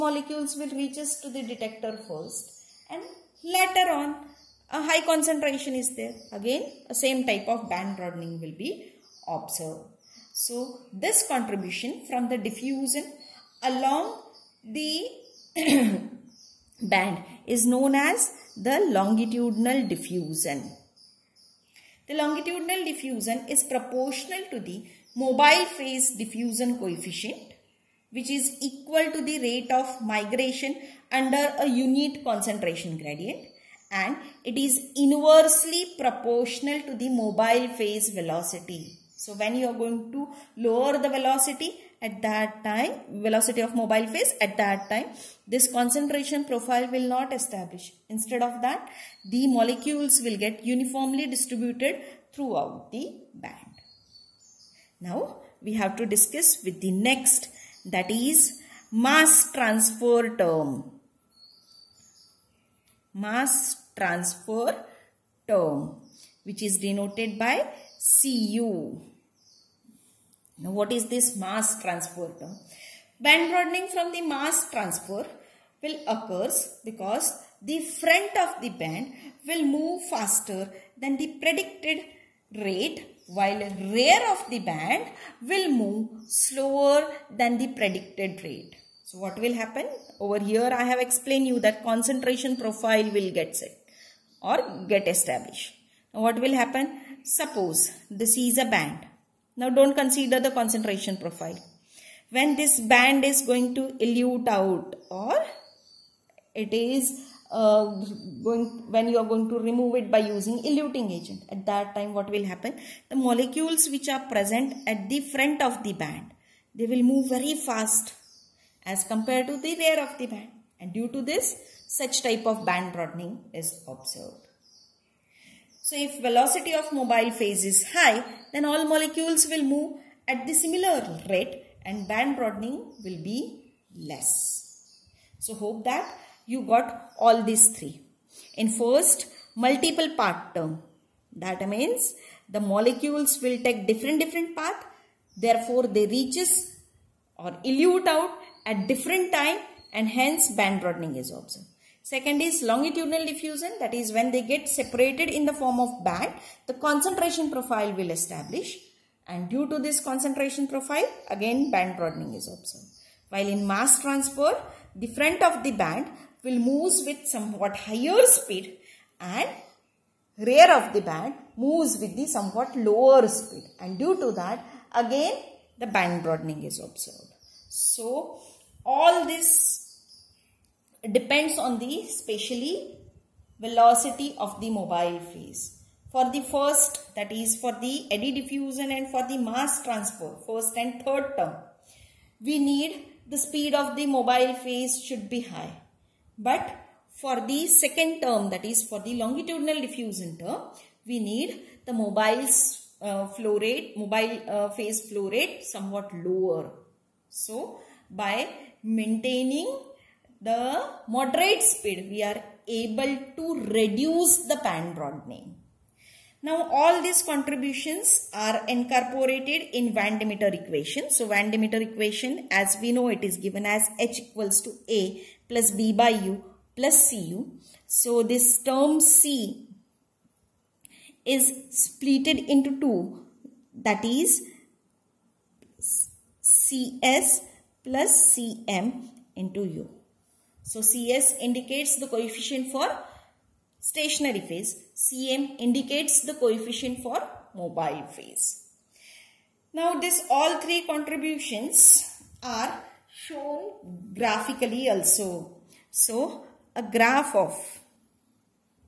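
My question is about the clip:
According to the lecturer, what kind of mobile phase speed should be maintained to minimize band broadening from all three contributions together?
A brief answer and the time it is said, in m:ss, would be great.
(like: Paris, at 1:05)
moderate speed, at 3:31.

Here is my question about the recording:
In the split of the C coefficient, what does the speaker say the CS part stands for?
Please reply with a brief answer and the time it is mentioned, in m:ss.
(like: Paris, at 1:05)
coefficient for stationary phase, at 4:02.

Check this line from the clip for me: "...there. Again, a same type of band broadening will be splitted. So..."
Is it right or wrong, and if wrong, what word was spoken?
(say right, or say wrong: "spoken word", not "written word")
wrong: "observed", not "splitted".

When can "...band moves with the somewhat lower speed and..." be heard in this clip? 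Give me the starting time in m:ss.
2:51.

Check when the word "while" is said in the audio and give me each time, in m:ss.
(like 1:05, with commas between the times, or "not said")
1:23, 2:43.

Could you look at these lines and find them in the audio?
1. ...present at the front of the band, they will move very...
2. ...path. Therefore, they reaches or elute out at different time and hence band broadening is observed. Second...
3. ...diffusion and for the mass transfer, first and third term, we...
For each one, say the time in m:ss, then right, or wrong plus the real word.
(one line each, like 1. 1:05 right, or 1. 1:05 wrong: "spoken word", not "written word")
1. 1:54 right
2. 2:24 right
3. 3:08 right.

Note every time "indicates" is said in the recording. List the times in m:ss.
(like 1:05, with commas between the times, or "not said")
4:01, 4:05.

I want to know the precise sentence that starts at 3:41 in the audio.
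So Van de equation as we know it is given as H equals to A plus B by U plus Cu.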